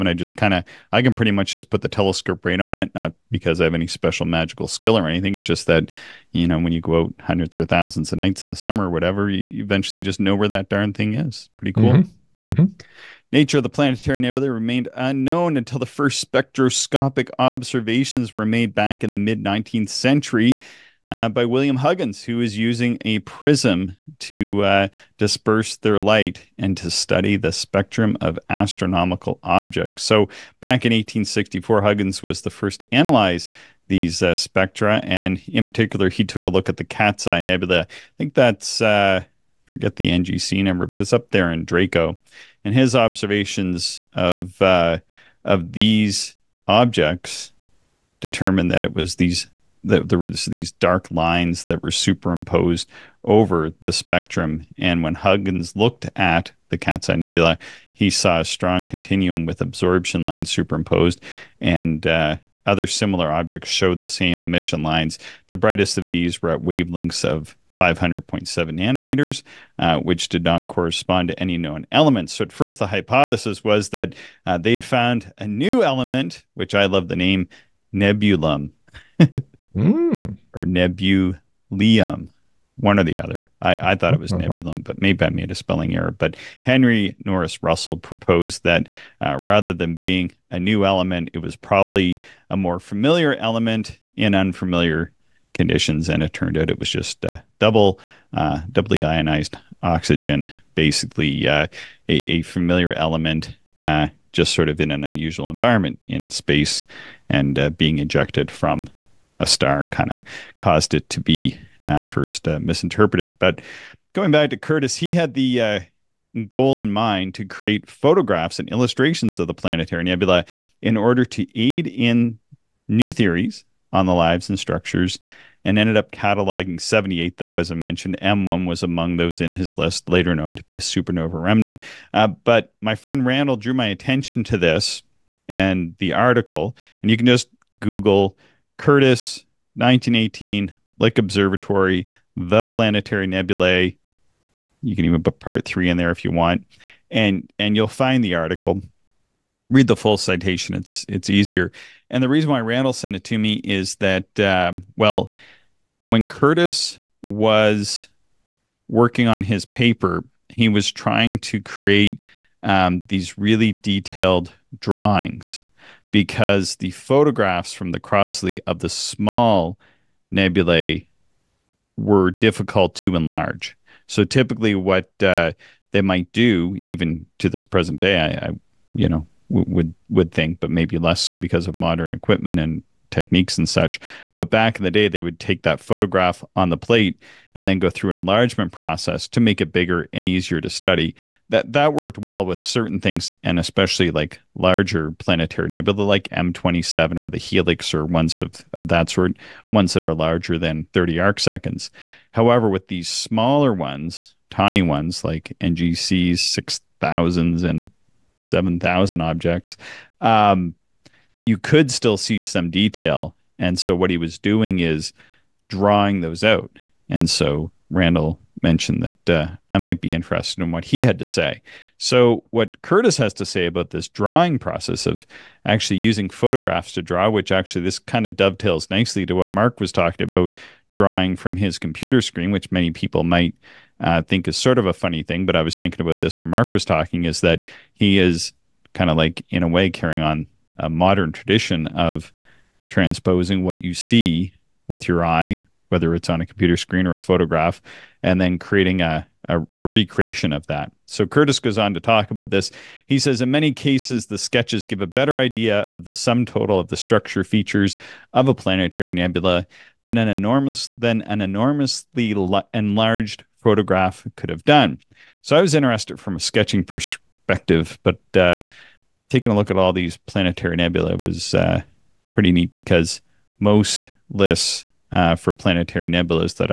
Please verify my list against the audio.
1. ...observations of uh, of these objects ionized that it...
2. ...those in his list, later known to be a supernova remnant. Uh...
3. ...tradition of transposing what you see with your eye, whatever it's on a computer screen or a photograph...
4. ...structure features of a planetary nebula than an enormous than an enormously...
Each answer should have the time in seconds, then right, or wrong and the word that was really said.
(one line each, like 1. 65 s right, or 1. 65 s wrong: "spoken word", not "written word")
1. 42 s wrong: "determined", not "ionized"
2. 129 s right
3. 241 s wrong: "whether", not "whatever"
4. 256 s right.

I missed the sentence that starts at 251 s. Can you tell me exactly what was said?
So Curtis goes on to talk about this.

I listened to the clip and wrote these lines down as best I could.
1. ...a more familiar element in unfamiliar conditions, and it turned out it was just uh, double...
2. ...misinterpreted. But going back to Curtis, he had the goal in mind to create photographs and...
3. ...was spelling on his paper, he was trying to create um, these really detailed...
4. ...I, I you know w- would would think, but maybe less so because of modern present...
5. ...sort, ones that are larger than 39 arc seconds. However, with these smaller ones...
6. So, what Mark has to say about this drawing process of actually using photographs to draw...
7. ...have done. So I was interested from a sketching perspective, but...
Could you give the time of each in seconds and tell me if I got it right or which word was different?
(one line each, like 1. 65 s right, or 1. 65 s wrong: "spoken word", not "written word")
1. 92 s right
2. 112 s right
3. 157 s wrong: "working", not "spelling"
4. 178 s wrong: "equipment", not "present"
5. 199 s wrong: "30", not "39"
6. 221 s wrong: "Curtis", not "Mark"
7. 264 s right.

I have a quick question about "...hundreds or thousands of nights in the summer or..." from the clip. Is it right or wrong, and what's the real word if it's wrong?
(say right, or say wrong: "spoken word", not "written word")
right.